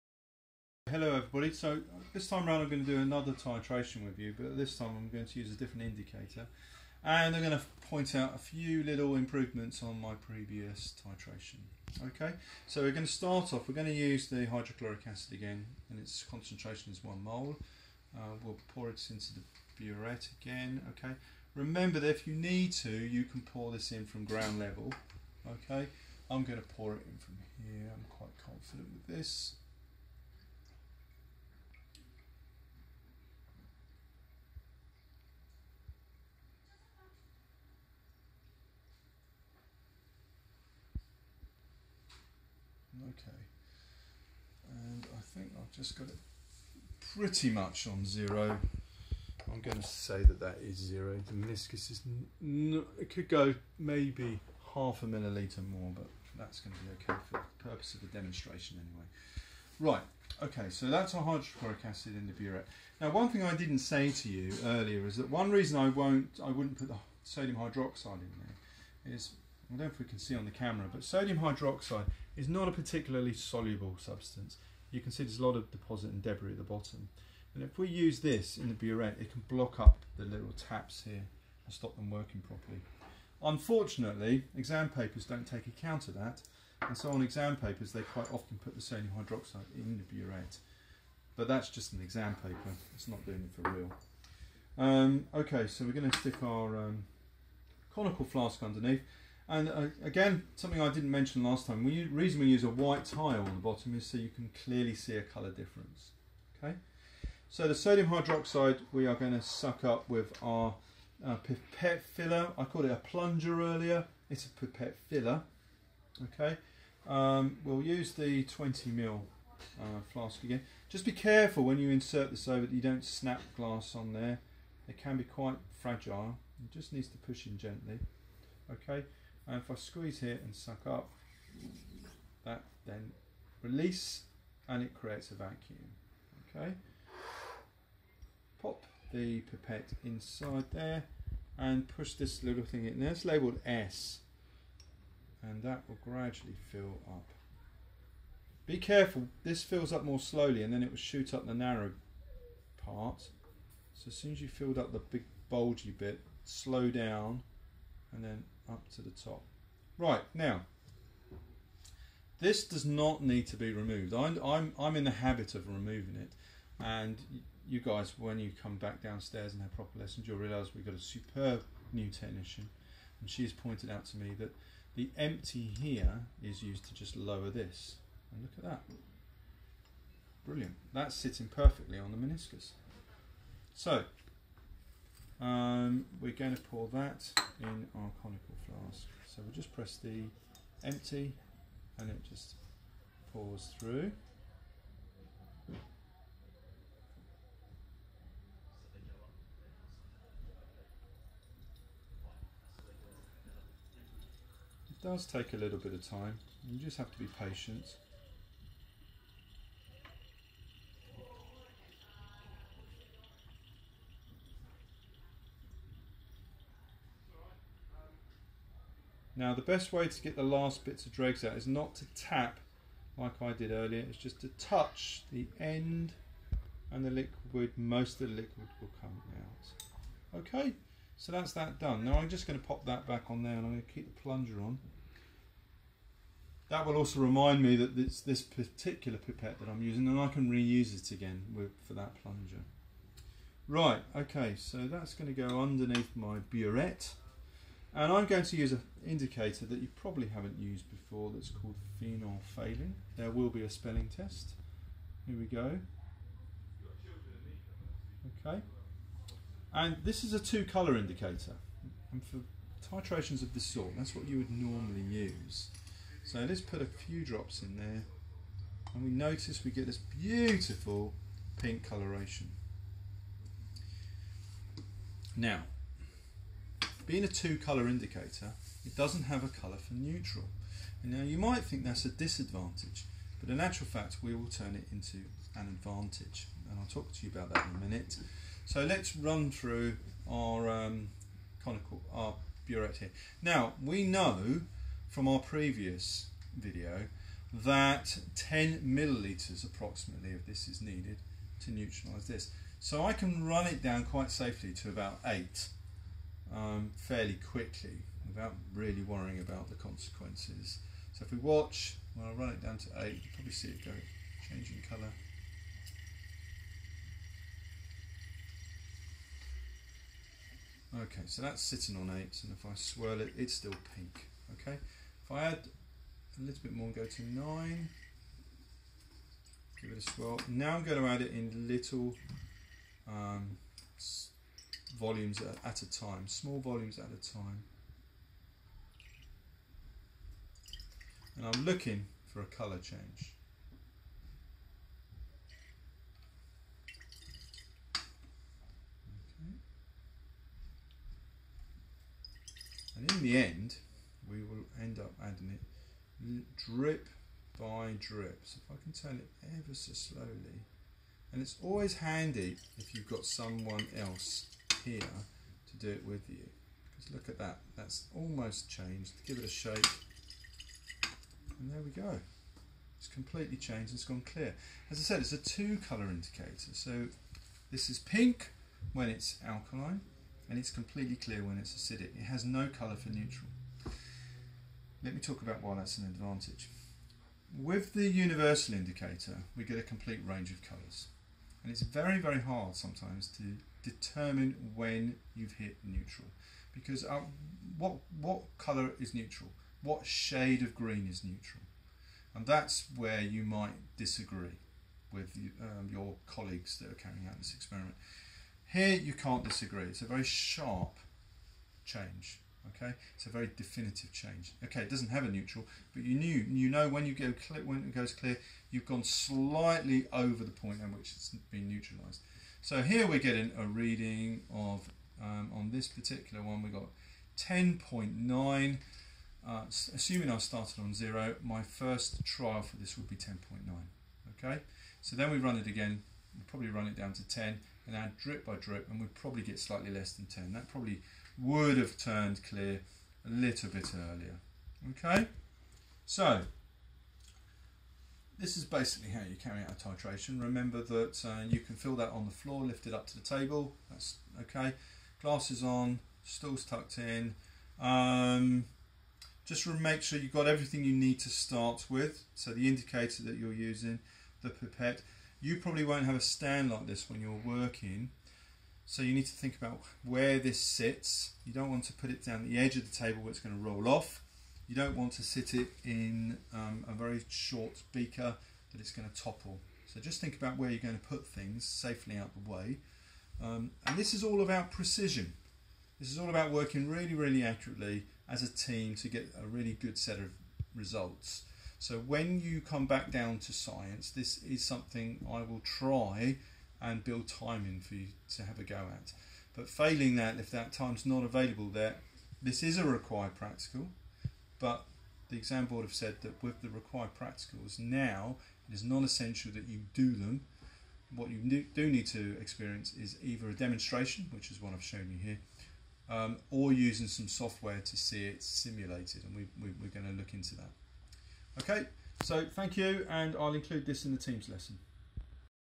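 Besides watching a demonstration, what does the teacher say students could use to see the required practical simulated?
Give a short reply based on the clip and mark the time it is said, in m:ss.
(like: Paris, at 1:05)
software, at 8:37.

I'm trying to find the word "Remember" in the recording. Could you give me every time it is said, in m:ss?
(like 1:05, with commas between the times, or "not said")
0:21, 7:30.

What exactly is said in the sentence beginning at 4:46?
And I'll talk to you about that in a minute.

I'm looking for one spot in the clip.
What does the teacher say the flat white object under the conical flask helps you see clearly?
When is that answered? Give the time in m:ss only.
1:45.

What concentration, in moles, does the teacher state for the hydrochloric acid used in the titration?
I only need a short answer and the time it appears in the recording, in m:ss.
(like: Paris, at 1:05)
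1 mole, at 0:17.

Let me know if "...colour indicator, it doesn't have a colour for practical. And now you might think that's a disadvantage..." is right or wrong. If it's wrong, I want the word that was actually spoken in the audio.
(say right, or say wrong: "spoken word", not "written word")
wrong: "neutral", not "practical".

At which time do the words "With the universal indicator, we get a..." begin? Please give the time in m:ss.
6:27.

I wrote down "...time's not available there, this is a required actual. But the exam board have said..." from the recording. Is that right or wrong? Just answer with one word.
wrong.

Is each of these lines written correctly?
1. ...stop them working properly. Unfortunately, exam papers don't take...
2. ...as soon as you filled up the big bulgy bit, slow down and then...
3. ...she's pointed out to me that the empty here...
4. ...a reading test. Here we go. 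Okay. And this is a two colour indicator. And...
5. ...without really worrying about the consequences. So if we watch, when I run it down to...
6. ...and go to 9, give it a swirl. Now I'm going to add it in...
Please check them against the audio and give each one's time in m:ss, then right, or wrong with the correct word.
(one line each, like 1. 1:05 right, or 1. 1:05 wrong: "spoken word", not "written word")
1. 1:21 right
2. 2:34 right
3. 2:53 right
4. 4:13 wrong: "spelling", not "reading"
5. 5:08 right
6. 5:26 right.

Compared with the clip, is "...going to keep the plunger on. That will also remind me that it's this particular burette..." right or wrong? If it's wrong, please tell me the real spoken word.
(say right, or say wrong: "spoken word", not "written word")
wrong: "pipette", not "burette".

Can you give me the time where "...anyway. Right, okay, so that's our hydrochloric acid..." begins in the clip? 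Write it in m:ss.
0:58.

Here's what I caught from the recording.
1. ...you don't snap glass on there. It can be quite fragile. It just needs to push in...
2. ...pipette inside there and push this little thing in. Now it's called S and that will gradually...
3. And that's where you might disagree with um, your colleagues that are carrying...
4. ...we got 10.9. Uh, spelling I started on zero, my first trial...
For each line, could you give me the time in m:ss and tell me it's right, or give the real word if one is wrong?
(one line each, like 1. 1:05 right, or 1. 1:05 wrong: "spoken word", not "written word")
1. 2:02 right
2. 2:19 wrong: "labeled", not "called"
3. 6:42 right
4. 7:06 wrong: "assuming", not "spelling".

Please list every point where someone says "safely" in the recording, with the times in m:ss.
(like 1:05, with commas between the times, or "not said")
5:04, 8:01.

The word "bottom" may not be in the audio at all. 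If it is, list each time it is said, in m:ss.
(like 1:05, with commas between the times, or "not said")
1:16, 1:43.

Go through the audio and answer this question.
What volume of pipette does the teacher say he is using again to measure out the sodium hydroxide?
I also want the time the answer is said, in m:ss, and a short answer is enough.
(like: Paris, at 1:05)
20 ml, at 1:58.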